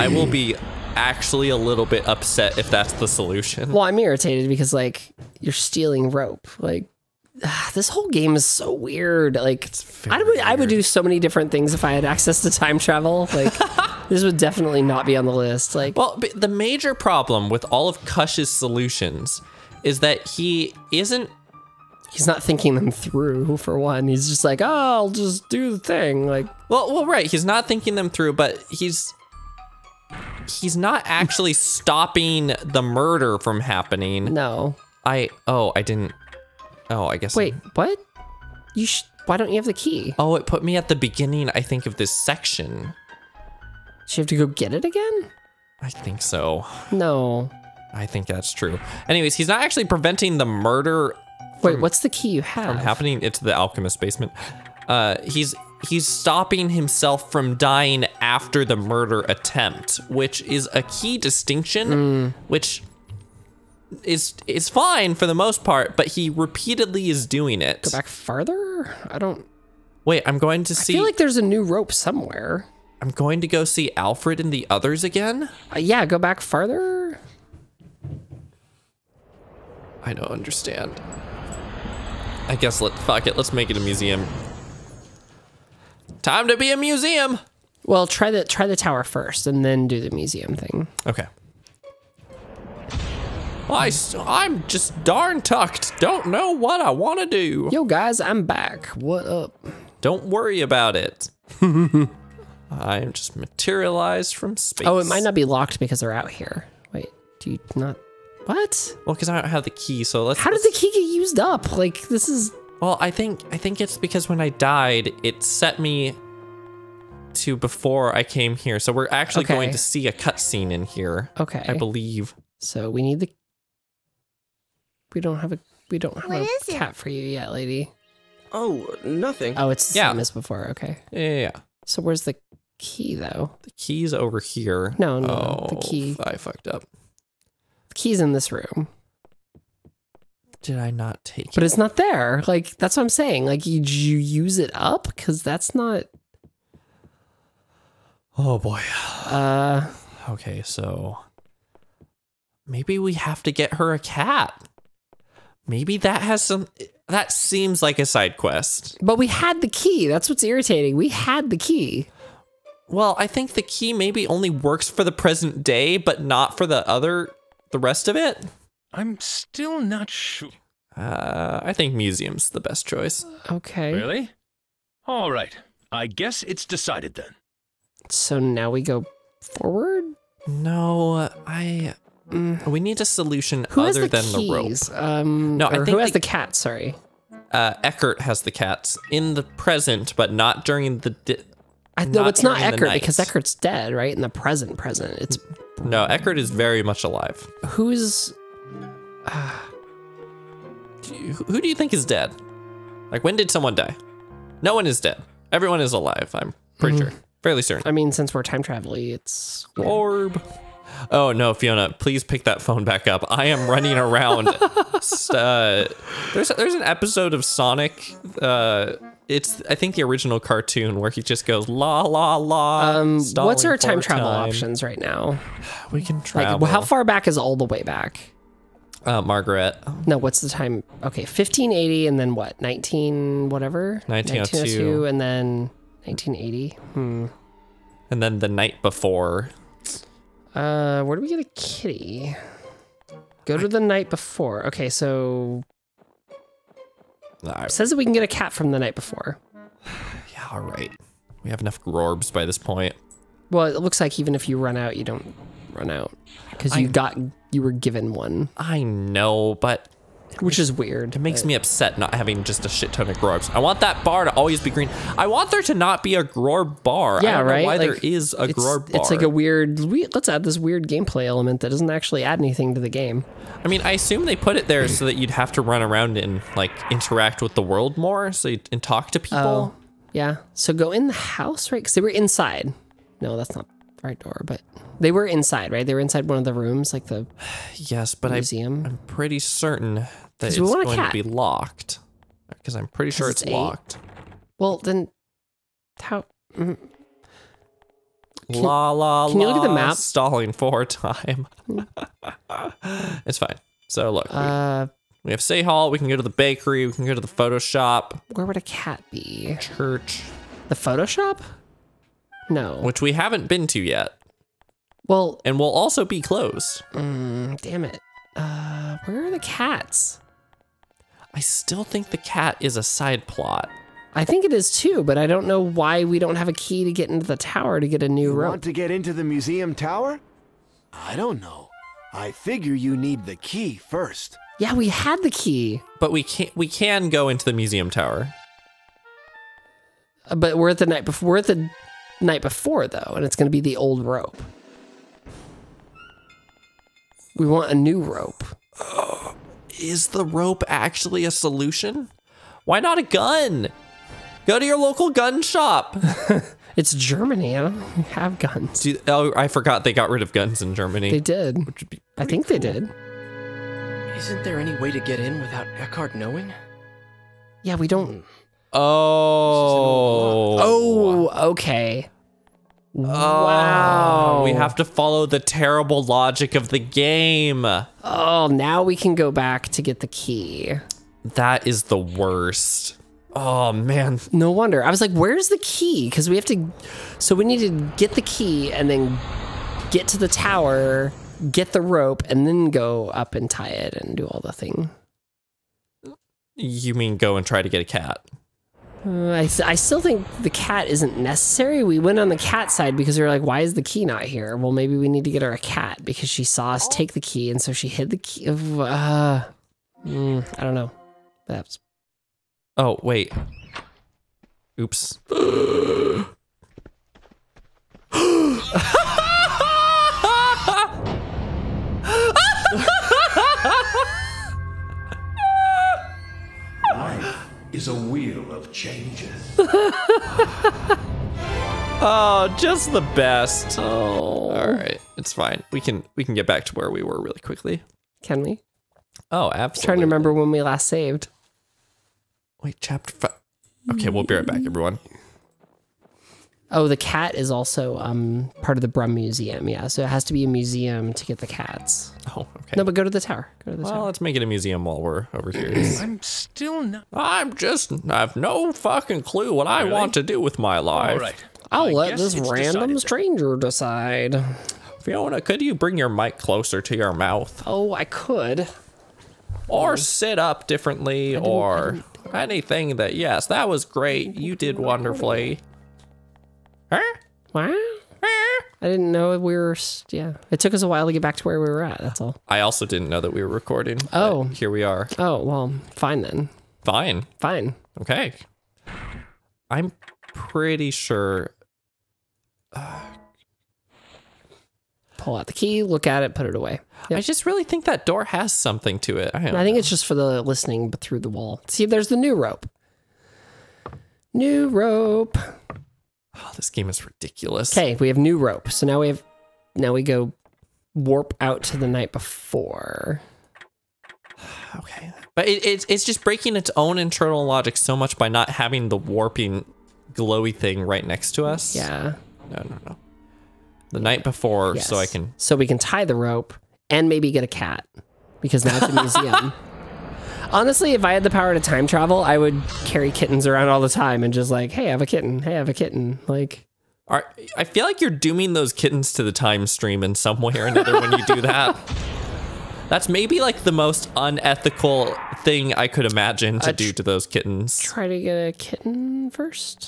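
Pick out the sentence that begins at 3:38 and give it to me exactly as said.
Uh, it's I think the original cartoon where he just goes la la la.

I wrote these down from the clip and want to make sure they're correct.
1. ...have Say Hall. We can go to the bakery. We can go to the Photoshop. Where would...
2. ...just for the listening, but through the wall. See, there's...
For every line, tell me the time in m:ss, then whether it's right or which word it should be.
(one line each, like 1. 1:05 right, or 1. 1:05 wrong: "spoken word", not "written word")
1. 5:05 right
2. 8:19 right.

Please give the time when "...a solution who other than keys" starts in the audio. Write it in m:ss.
3:02.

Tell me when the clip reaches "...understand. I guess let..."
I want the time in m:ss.
1:20.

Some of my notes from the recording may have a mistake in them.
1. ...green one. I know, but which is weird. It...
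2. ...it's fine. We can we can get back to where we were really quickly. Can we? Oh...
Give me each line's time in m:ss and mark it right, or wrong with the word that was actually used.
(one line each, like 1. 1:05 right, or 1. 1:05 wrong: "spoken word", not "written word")
1. 4:17 wrong: "given", not "green"
2. 7:15 right.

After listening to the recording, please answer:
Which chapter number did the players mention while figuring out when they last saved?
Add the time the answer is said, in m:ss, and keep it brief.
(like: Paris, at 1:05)
5, at 7:22.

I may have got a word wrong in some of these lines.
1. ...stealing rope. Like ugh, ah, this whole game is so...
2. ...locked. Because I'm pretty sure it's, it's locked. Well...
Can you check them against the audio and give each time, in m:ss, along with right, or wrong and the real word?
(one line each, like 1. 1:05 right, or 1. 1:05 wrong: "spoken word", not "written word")
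1. 0:05 right
2. 4:51 right.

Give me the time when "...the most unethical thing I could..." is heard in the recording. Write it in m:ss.
9:03.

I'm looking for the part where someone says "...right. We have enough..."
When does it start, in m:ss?
4:10.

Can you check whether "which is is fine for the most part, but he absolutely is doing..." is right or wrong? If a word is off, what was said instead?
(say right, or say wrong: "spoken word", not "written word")
wrong: "repeatedly", not "absolutely".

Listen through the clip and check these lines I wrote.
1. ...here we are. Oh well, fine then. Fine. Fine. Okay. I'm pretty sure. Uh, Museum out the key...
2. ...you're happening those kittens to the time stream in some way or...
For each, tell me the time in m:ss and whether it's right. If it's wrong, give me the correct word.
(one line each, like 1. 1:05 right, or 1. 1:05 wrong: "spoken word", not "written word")
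1. 8:04 wrong: "Pull", not "Museum"
2. 8:57 wrong: "dooming", not "happening".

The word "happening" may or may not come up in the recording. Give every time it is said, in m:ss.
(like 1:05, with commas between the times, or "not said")
0:33, 0:52.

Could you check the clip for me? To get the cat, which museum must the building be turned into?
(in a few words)
Brum Museum.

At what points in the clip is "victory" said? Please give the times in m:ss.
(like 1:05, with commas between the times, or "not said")
not said.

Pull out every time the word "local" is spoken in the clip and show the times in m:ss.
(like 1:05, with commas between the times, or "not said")
5:54.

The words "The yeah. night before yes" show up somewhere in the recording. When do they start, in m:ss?
8:43.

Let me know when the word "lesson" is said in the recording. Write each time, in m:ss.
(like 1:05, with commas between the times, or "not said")
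not said.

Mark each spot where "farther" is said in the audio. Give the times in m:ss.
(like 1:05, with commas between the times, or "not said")
1:08, 1:16.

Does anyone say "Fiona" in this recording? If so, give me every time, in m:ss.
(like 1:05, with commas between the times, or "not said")
3:31, 7:45.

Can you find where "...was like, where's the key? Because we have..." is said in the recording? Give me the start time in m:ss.
6:24.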